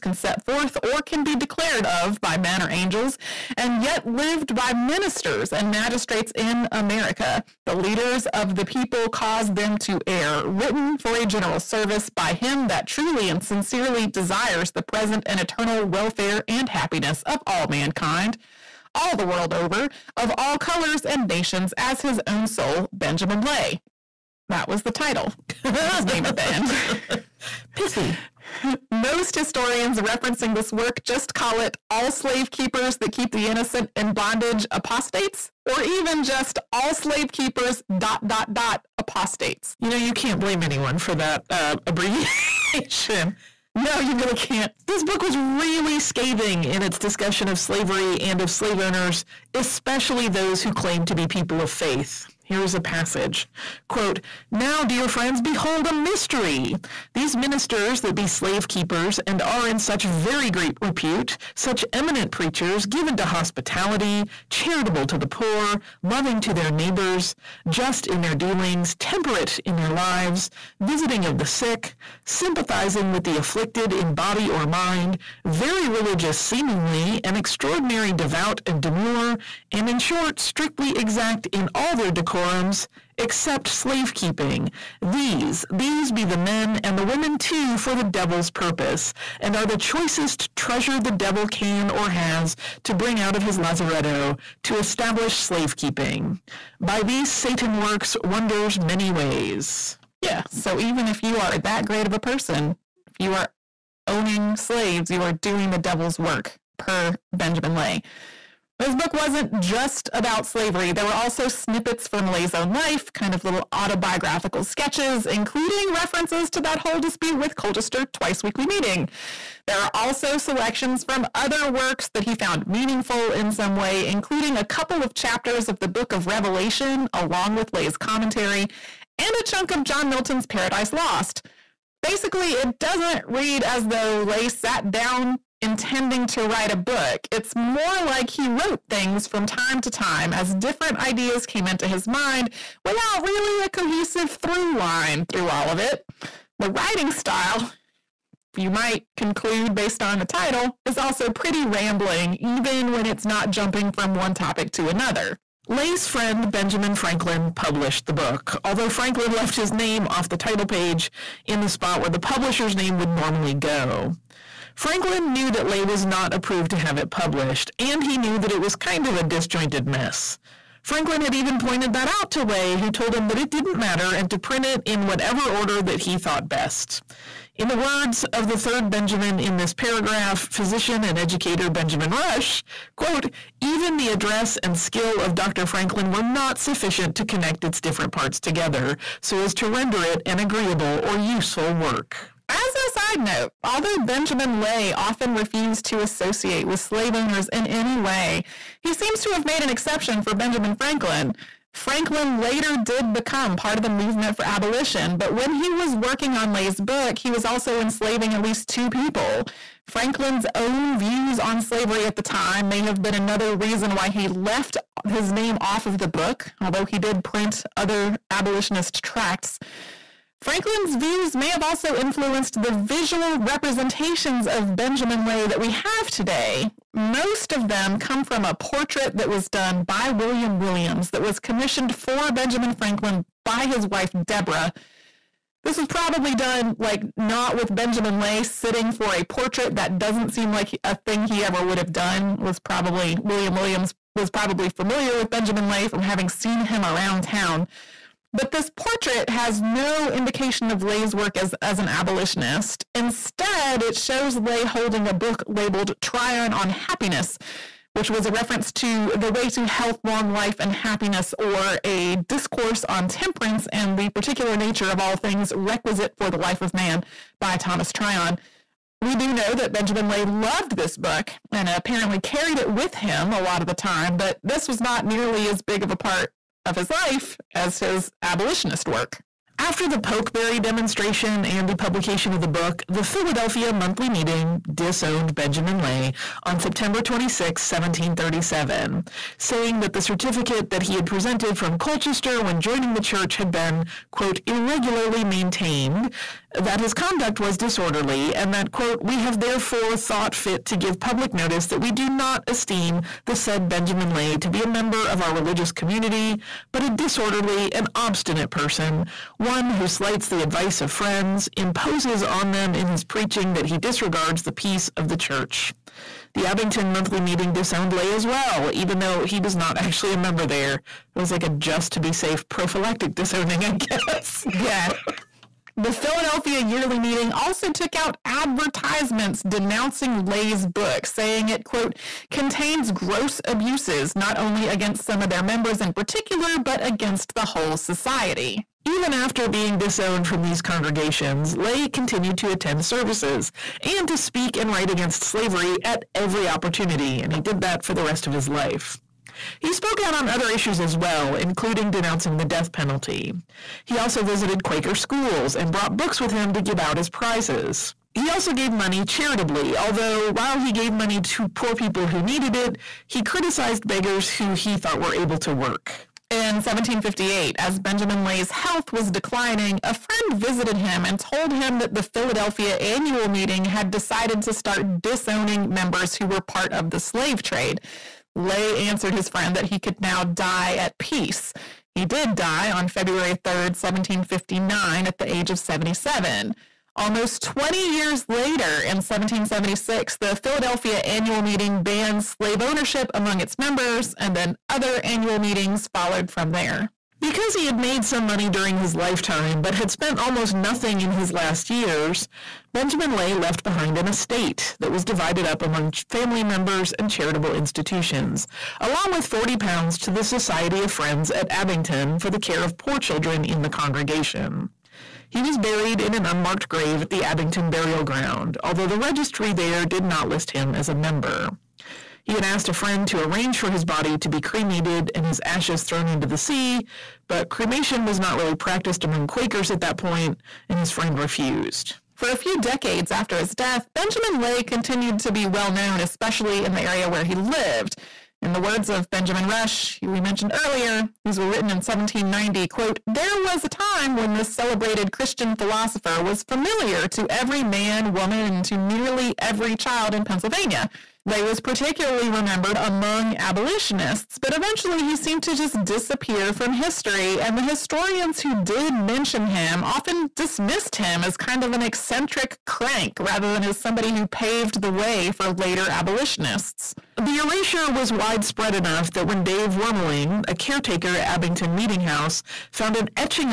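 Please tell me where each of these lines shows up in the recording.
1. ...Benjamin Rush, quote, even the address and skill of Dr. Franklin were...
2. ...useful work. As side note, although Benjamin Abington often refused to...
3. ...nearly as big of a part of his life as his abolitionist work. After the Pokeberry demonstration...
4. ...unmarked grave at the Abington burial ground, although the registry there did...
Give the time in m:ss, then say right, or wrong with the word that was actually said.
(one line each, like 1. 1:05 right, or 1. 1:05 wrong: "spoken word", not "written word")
1. 3:01 right
2. 3:11 wrong: "Lay", not "Abington"
3. 4:35 right
4. 6:56 right.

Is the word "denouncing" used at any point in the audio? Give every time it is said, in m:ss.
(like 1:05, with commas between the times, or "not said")
5:29, 5:51.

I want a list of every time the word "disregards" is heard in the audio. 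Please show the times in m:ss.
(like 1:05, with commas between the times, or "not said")
5:13.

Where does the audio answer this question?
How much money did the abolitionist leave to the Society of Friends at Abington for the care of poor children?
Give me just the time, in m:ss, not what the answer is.
6:49.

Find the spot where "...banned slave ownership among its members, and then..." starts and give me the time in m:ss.
6:31.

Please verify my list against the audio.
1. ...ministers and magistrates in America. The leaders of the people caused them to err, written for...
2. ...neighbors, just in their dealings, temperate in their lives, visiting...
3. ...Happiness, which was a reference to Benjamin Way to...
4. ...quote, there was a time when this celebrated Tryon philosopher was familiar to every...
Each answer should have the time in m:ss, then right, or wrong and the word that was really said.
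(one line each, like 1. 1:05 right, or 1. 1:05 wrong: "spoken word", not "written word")
1. 0:04 right
2. 1:06 right
3. 4:16 wrong: "The", not "Benjamin"
4. 7:22 wrong: "Christian", not "Tryon".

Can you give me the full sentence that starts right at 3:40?
Franklin's views may have also influenced the visual representations of Benjamin Lay that we have today.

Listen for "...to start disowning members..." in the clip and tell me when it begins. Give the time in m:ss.
6:14.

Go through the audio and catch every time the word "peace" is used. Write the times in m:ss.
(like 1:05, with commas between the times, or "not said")
5:14, 6:20.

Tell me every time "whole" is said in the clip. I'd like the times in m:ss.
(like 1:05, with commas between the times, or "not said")
1:56, 5:37.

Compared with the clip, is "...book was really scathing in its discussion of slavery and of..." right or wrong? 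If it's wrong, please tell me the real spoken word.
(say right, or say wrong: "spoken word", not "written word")
right.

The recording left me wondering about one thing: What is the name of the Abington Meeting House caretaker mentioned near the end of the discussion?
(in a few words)
Dave Wormeling.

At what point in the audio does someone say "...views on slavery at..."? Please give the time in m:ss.
3:30.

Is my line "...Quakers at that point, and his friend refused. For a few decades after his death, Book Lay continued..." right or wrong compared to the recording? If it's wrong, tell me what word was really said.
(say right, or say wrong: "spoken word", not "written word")
wrong: "Benjamin", not "Book".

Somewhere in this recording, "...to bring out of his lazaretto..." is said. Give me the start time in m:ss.
1:32.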